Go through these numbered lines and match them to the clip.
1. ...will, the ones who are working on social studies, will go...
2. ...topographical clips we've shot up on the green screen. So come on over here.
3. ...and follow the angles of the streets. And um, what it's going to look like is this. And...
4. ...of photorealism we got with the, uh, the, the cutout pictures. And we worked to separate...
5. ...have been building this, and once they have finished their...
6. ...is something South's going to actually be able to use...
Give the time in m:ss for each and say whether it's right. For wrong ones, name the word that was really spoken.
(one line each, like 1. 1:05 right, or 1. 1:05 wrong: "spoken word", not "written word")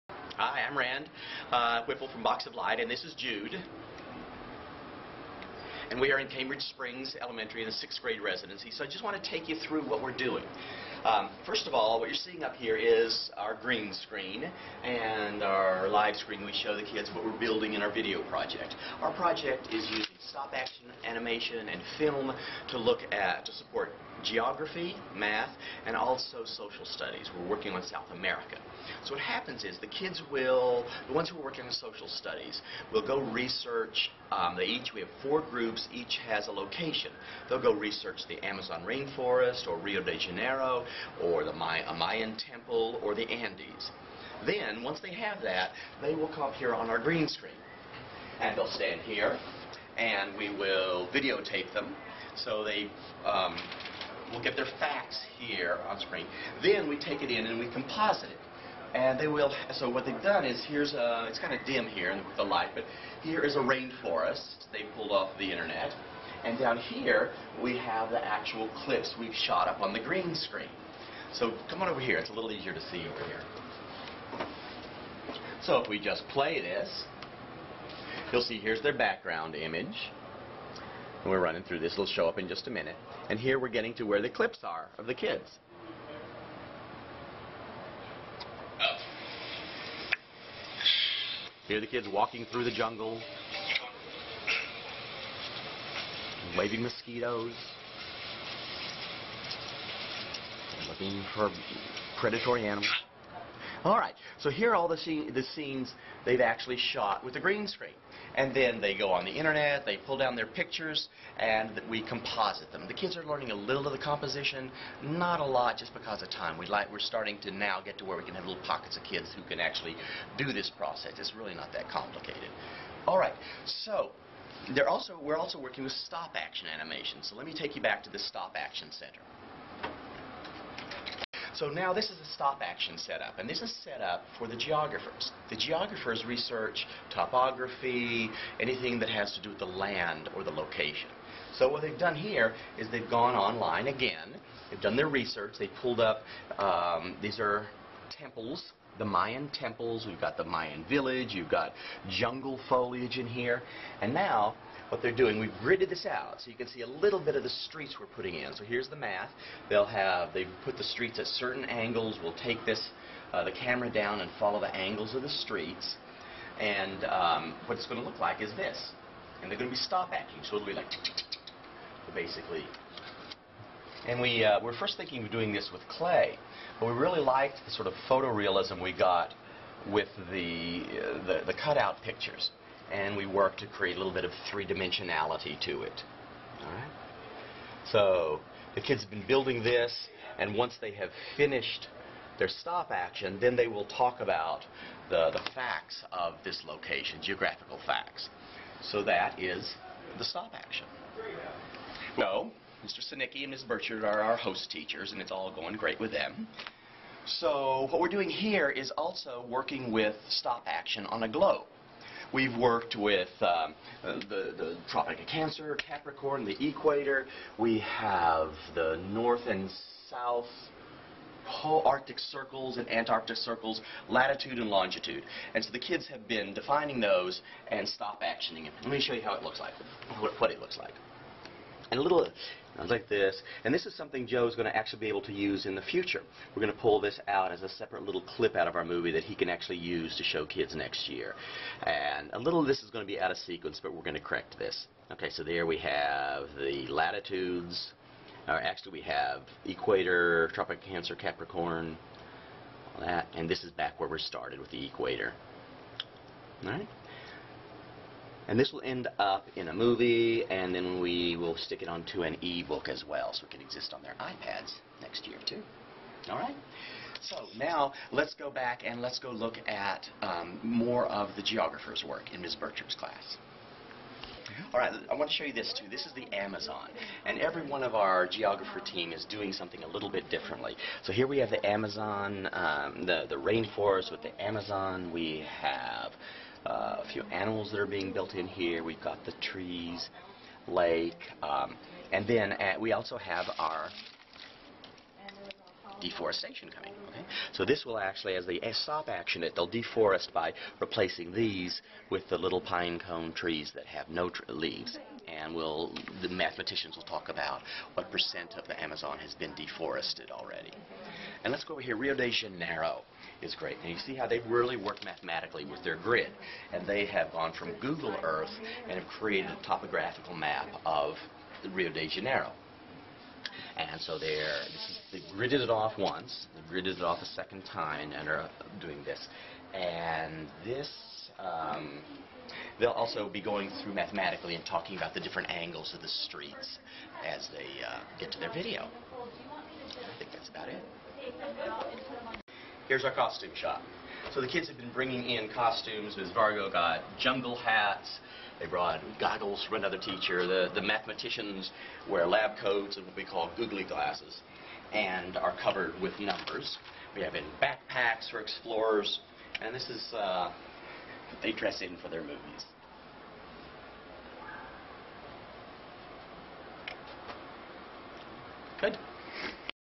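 1. 0:30 right
2. 1:08 wrong: "actual", not "topographical"
3. 2:44 right
4. 2:57 wrong: "create", not "separate"
5. 3:09 right
6. 3:53 wrong: "Joe", not "South".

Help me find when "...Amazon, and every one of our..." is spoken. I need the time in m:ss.
4:36.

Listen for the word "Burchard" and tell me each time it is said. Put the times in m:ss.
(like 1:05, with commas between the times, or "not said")
3:23.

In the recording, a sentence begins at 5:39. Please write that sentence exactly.
I think that's about it here's our costume shop.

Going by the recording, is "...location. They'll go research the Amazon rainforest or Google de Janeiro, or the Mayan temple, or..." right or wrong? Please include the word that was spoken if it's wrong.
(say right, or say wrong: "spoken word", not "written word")
wrong: "Rio", not "Google".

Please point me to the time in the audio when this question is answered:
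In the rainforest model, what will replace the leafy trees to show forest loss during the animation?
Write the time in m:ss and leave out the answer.
5:02.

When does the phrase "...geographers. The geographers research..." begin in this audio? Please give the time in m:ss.
2:14.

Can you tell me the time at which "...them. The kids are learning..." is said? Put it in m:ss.
1:52.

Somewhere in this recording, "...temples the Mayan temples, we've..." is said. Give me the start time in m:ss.
2:28.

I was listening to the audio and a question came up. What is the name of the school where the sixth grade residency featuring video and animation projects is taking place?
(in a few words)
Cambridge Springs Elementary.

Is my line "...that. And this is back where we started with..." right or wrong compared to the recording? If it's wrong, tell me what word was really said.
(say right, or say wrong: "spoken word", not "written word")
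right.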